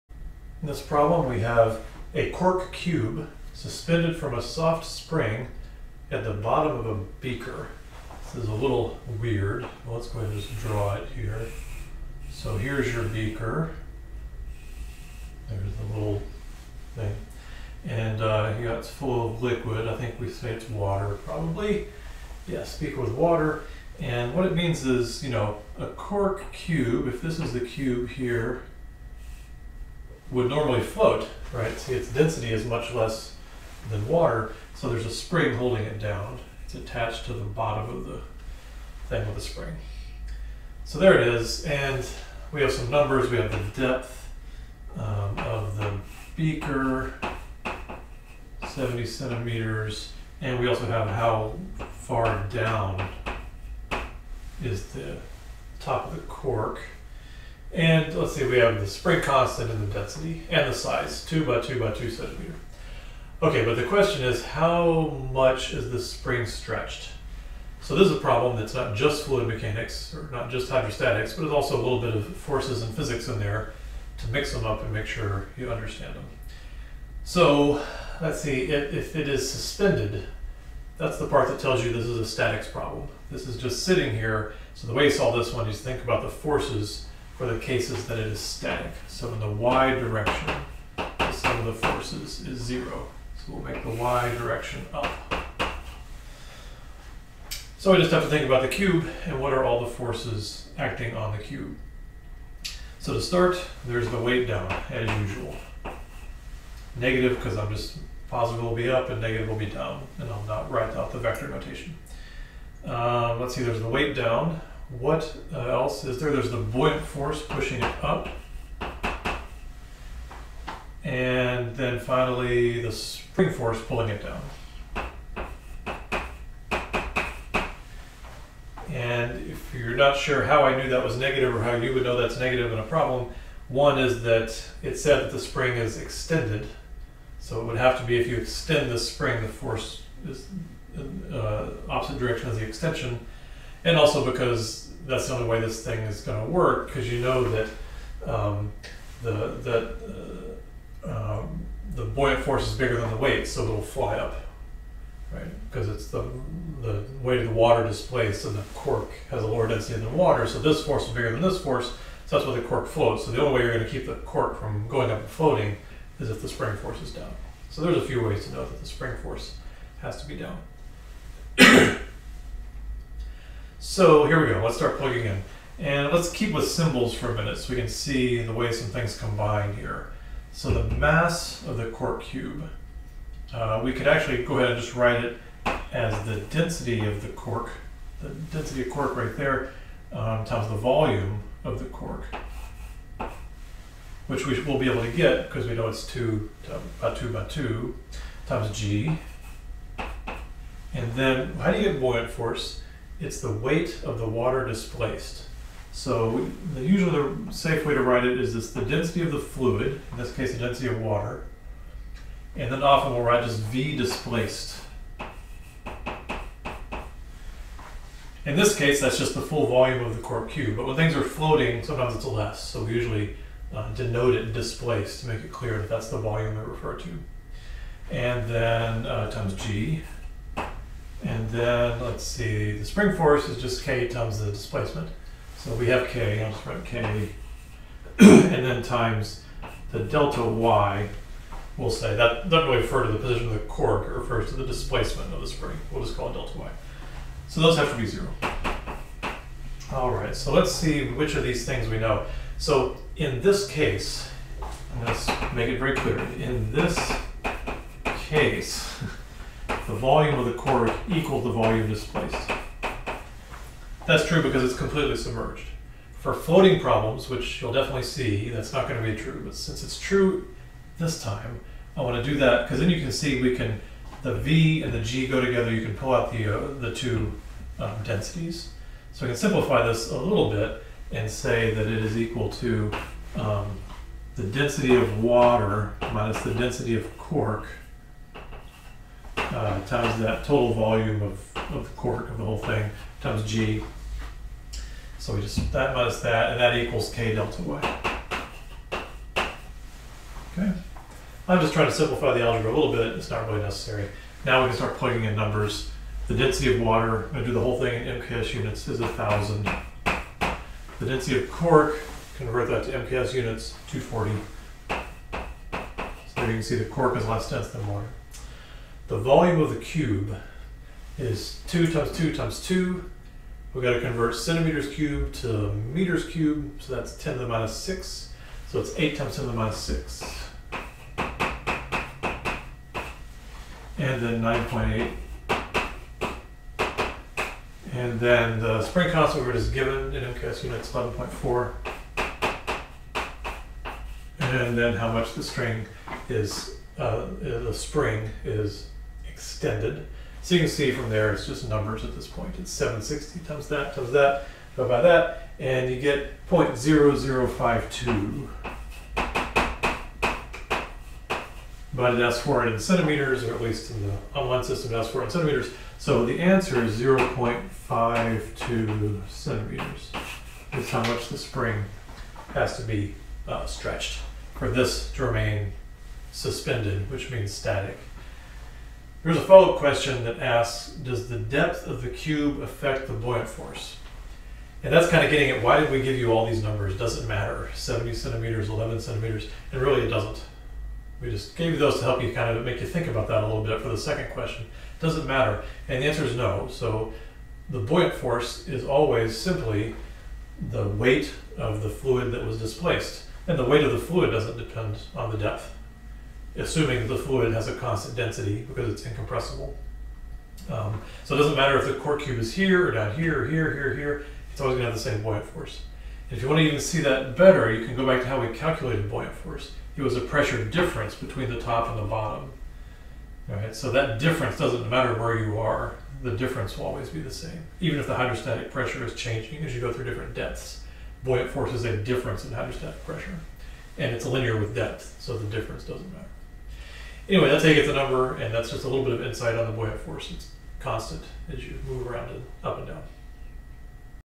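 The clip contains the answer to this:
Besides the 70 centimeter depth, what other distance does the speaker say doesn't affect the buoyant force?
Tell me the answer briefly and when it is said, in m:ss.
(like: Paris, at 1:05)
11 centimeters, at 6:28.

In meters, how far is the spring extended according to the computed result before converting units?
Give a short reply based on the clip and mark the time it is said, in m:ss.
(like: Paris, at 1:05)
0.0052, at 5:56.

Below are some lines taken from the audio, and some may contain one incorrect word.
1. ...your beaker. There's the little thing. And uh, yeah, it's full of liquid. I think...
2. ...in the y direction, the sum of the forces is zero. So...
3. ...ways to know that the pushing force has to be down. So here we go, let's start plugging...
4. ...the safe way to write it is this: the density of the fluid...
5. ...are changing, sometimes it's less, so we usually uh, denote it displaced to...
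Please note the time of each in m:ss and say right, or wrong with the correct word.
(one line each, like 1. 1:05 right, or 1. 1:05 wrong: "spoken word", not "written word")
1. 0:12 right
2. 1:29 right
3. 2:48 wrong: "spring", not "pushing"
4. 3:27 right
5. 3:41 wrong: "floating", not "changing".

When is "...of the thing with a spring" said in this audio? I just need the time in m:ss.
0:37.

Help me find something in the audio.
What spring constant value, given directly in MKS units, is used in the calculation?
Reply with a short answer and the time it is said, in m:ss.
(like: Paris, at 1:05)
11.4, at 5:40.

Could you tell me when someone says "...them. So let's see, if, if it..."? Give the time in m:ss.
1:16.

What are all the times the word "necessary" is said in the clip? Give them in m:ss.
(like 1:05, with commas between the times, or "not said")
5:03.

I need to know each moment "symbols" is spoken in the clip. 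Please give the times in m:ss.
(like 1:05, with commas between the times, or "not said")
2:56.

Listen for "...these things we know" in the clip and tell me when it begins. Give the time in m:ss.
4:11.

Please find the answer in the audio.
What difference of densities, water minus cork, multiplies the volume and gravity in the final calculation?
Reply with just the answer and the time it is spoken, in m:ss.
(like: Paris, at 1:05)
760, at 5:52.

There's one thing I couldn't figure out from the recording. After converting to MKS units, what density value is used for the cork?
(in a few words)
240.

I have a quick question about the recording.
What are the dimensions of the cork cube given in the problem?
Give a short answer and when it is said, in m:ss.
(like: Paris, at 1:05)
2 by 2 by 2 centimeters, at 1:01.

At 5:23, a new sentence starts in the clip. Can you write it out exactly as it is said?
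We've got to convert centimeters cubed to meters cubed, so that's 10 to the minus 6.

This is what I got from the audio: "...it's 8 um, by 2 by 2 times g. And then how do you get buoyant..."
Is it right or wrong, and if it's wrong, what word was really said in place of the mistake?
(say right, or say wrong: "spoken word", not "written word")
wrong: "2", not "8".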